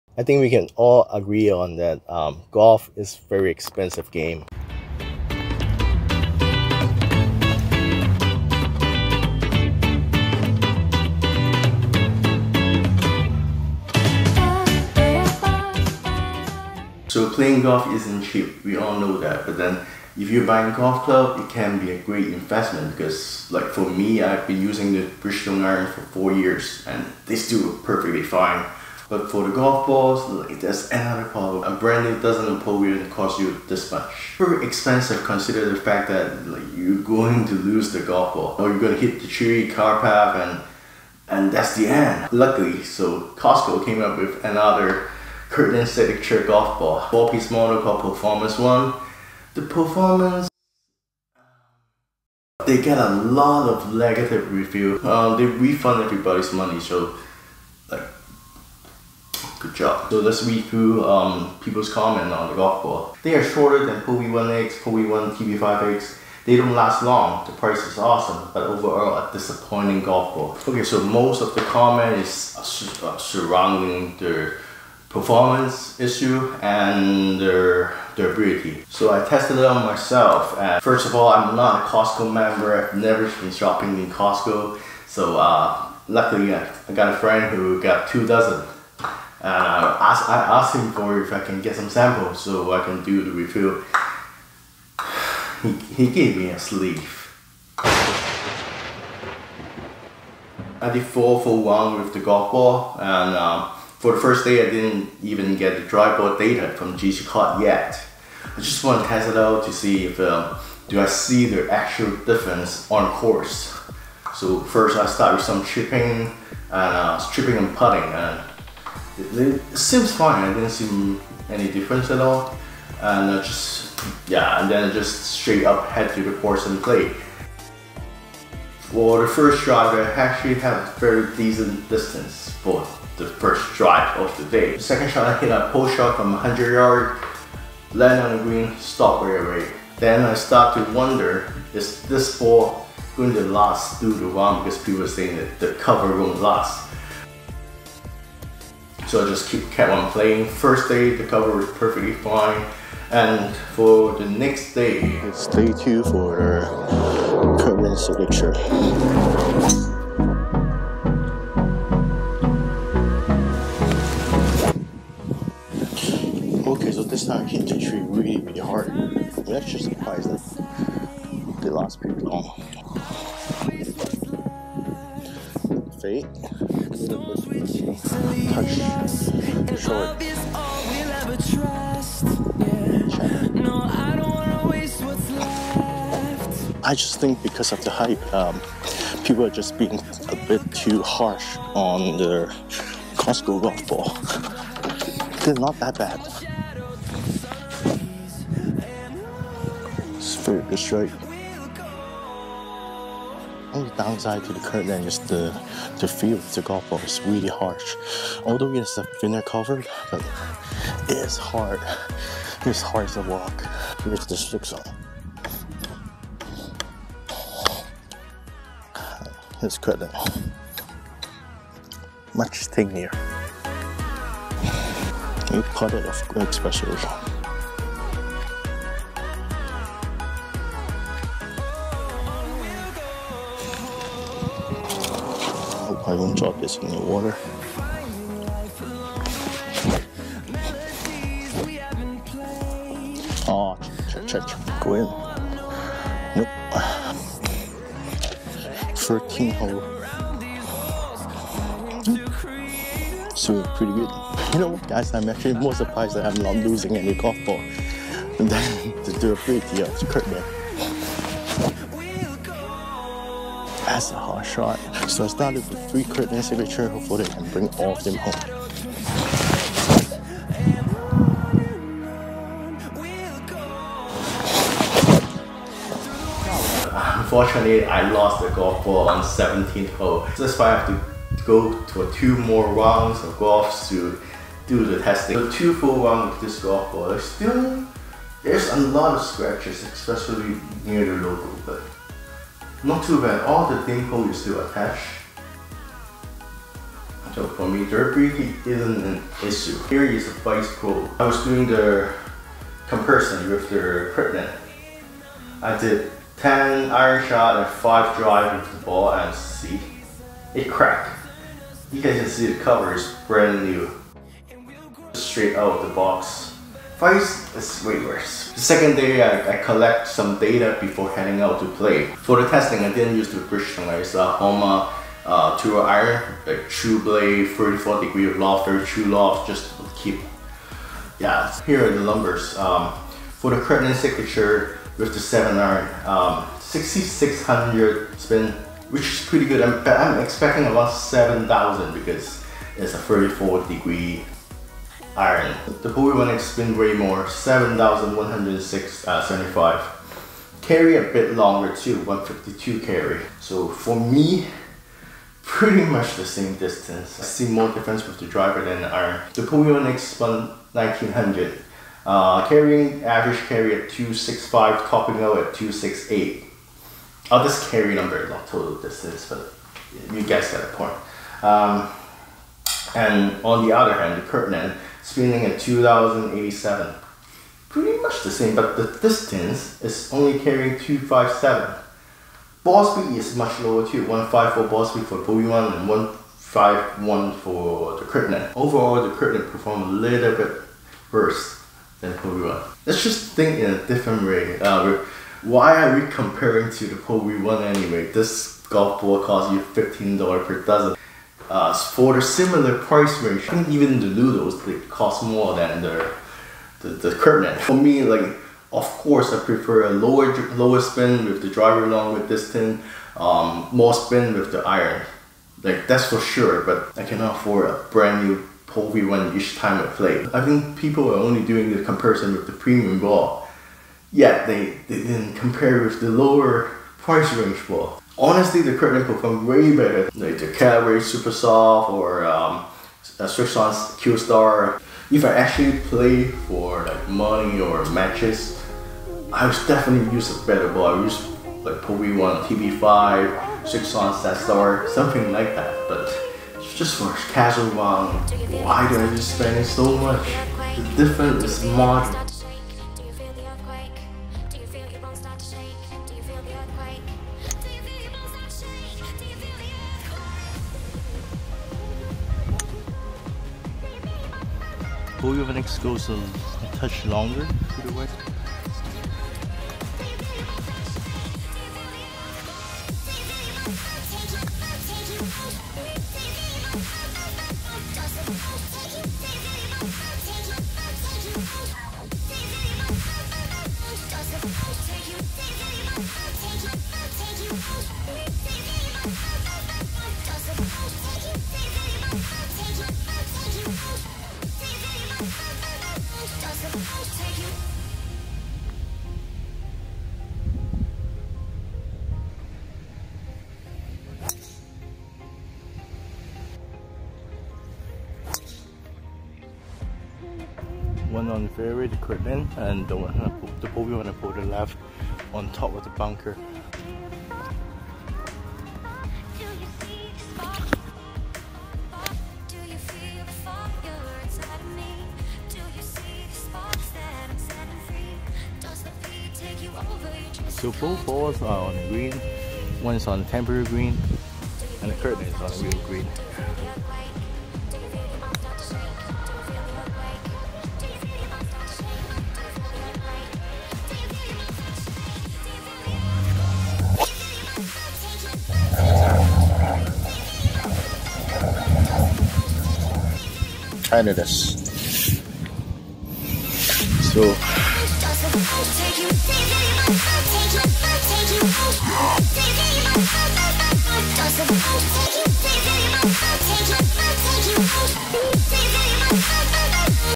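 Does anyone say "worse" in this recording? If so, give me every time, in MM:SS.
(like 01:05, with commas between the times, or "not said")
05:18, 06:31.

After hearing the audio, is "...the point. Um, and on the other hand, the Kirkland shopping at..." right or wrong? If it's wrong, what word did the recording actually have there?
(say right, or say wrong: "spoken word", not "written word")
wrong: "spinning", not "shopping".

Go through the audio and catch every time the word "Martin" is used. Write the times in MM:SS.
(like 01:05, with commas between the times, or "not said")
not said.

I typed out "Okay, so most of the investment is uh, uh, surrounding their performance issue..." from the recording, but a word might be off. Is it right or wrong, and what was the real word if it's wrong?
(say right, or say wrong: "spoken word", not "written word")
wrong: "comment", not "investment".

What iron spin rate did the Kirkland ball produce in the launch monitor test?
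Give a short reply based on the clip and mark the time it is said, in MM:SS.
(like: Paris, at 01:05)
6600, at 05:36.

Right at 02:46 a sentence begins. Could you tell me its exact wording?
Okay, so this time I hit the tree really, really hard.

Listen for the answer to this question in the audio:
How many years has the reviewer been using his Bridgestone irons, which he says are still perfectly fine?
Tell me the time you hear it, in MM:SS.
00:26.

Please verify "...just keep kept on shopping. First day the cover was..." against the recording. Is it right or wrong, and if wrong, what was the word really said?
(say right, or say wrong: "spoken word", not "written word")
wrong: "playing", not "shopping".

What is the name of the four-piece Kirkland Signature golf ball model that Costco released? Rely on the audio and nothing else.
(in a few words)
Performance One.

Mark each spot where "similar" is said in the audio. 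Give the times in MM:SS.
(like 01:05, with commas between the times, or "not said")
06:42.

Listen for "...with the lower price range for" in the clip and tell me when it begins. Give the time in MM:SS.
07:05.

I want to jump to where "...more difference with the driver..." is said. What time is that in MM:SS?
05:57.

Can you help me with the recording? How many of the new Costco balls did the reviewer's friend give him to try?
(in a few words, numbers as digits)
A sleeve.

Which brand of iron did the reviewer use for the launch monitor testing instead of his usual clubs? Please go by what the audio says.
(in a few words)
Homa.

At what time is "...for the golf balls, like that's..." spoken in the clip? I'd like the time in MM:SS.
00:29.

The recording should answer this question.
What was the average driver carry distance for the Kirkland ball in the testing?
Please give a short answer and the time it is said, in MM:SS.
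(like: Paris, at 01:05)
257, at 06:20.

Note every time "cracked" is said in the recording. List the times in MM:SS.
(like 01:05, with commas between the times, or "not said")
05:10.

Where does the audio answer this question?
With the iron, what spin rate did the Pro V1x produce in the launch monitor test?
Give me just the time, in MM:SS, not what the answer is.
05:47.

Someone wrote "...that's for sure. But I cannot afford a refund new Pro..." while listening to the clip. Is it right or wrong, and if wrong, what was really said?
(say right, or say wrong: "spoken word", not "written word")
wrong: "brand", not "refund".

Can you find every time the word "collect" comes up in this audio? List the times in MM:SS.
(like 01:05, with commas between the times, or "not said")
05:19.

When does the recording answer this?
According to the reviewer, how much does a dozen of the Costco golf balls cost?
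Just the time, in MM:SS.
06:39.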